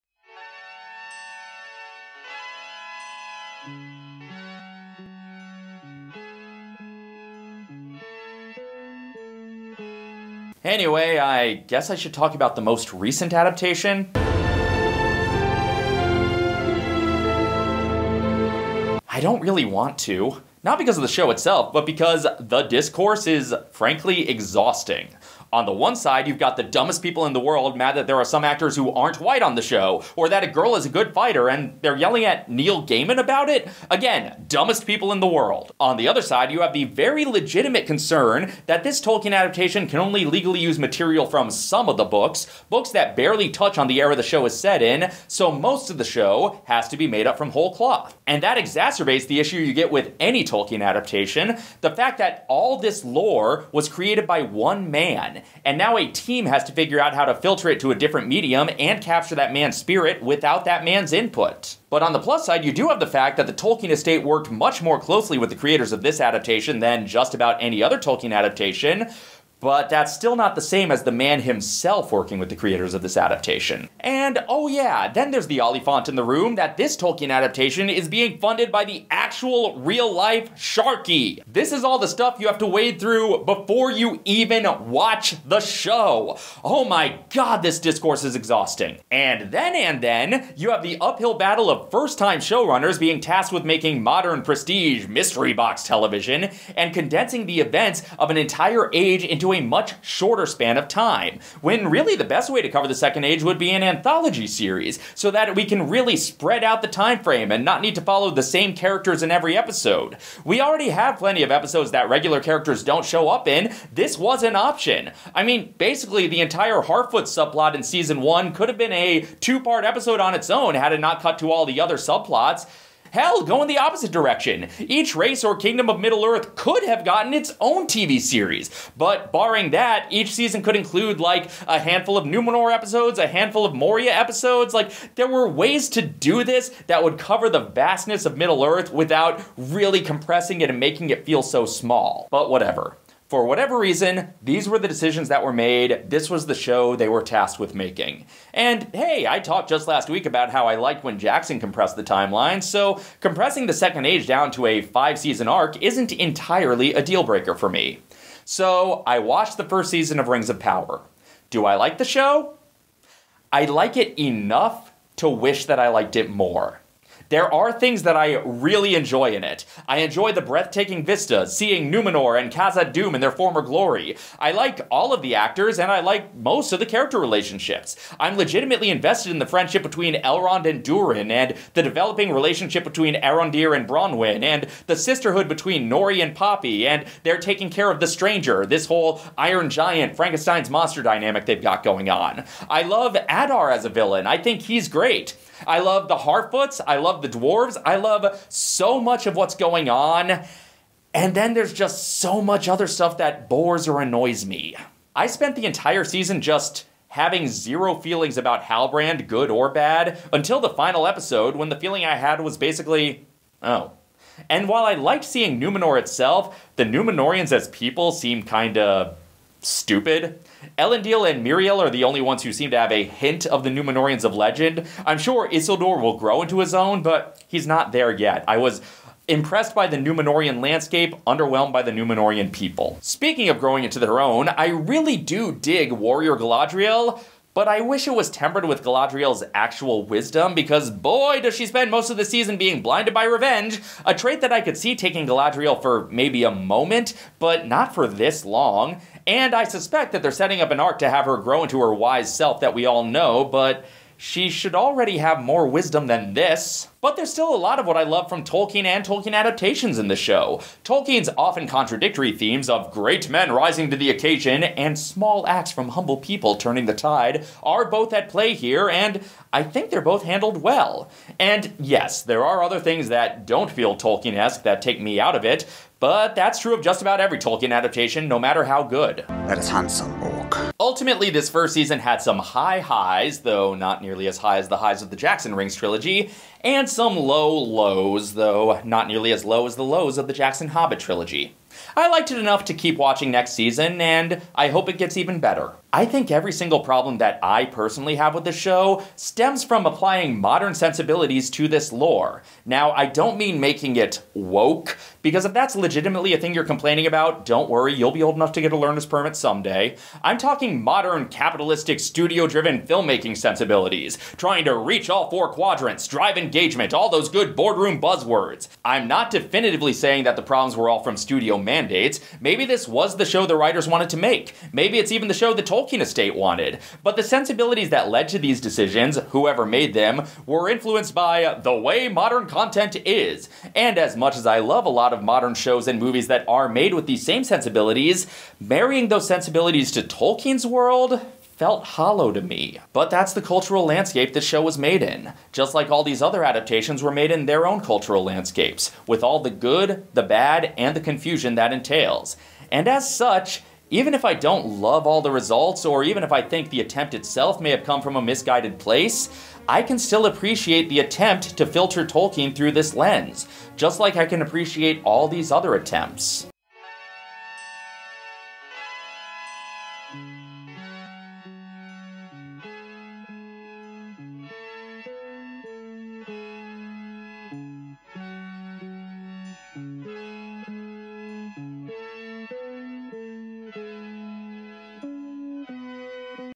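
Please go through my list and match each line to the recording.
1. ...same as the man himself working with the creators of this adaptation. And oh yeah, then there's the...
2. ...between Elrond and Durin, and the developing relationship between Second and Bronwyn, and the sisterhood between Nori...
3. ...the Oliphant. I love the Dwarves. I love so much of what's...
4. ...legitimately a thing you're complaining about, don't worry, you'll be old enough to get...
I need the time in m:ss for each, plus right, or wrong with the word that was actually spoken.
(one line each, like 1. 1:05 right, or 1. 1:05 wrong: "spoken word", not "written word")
1. 1:10 right
2. 2:59 wrong: "Arondir", not "Second"
3. 3:16 wrong: "Harfoots", not "Oliphant"
4. 5:05 right.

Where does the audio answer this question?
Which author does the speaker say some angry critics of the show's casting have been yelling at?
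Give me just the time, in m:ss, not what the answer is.
0:32.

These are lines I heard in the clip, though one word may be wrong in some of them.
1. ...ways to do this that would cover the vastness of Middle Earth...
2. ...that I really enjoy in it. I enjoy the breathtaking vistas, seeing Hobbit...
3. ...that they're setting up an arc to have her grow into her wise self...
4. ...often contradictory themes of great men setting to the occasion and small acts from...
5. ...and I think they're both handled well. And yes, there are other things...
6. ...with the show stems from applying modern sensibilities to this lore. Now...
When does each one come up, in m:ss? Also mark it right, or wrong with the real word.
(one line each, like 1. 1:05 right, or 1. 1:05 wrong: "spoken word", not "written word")
1. 2:15 right
2. 2:48 wrong: "Numenor", not "Hobbit"
3. 4:10 right
4. 4:21 wrong: "rising", not "setting"
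5. 4:28 right
6. 4:58 right.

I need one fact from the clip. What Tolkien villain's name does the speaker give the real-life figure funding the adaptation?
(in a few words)
Sharky.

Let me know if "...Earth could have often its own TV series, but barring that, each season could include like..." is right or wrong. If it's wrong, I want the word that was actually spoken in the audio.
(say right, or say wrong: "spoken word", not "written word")
wrong: "gotten", not "often".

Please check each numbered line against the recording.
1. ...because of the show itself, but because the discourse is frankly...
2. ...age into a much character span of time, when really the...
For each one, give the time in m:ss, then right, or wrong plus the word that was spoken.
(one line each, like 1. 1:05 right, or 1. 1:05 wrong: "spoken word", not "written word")
1. 0:20 right
2. 1:38 wrong: "shorter", not "character".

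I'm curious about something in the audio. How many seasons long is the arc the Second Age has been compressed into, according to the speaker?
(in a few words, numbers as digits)
5.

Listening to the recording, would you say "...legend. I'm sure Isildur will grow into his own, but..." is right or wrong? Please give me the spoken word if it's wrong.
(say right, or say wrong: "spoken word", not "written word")
right.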